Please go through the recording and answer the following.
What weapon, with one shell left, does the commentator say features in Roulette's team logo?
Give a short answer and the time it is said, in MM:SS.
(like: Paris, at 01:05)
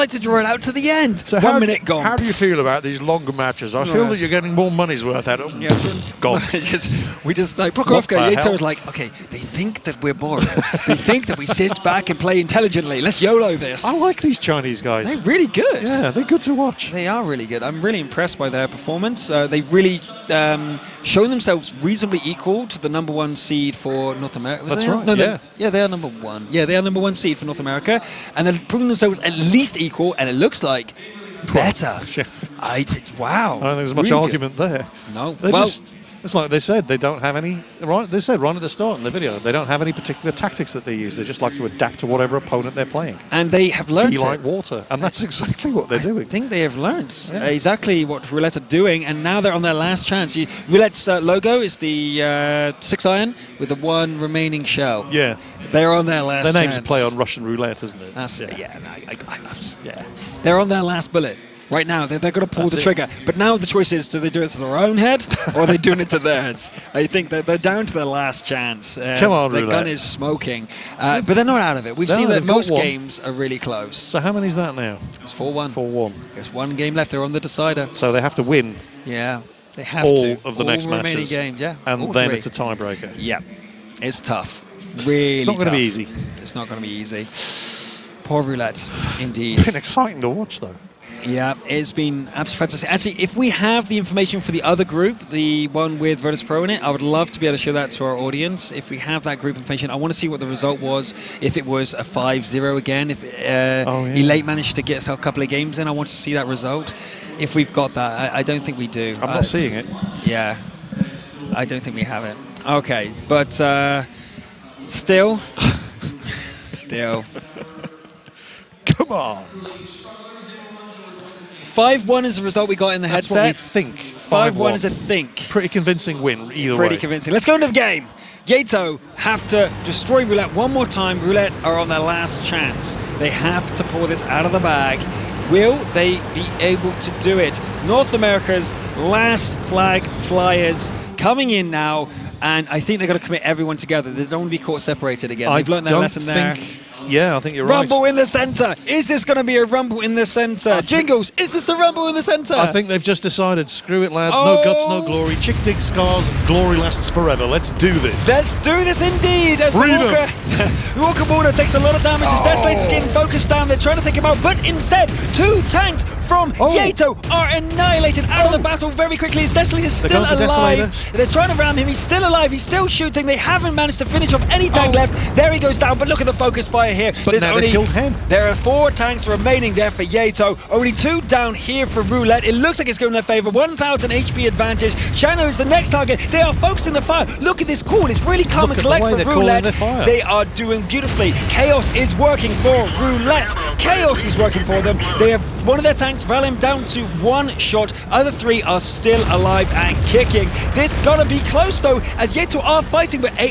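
Six iron, at 00:52.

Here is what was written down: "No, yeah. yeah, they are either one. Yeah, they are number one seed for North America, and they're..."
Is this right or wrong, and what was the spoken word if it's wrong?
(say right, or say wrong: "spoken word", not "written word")
wrong: "number", not "either".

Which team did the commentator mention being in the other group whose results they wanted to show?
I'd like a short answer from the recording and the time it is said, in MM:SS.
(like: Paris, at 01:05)
Virtus Pro, at 01:36.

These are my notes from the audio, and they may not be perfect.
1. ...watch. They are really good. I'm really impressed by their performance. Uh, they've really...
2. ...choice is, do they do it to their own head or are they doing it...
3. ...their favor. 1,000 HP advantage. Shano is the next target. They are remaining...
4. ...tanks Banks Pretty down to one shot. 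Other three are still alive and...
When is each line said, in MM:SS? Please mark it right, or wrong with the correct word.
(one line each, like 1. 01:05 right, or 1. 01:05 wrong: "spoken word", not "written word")
1. 00:16 right
2. 01:03 right
3. 03:03 wrong: "focusing", not "remaining"
4. 03:15 wrong: "Vellum", not "Pretty".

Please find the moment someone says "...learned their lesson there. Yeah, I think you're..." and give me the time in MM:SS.
02:25.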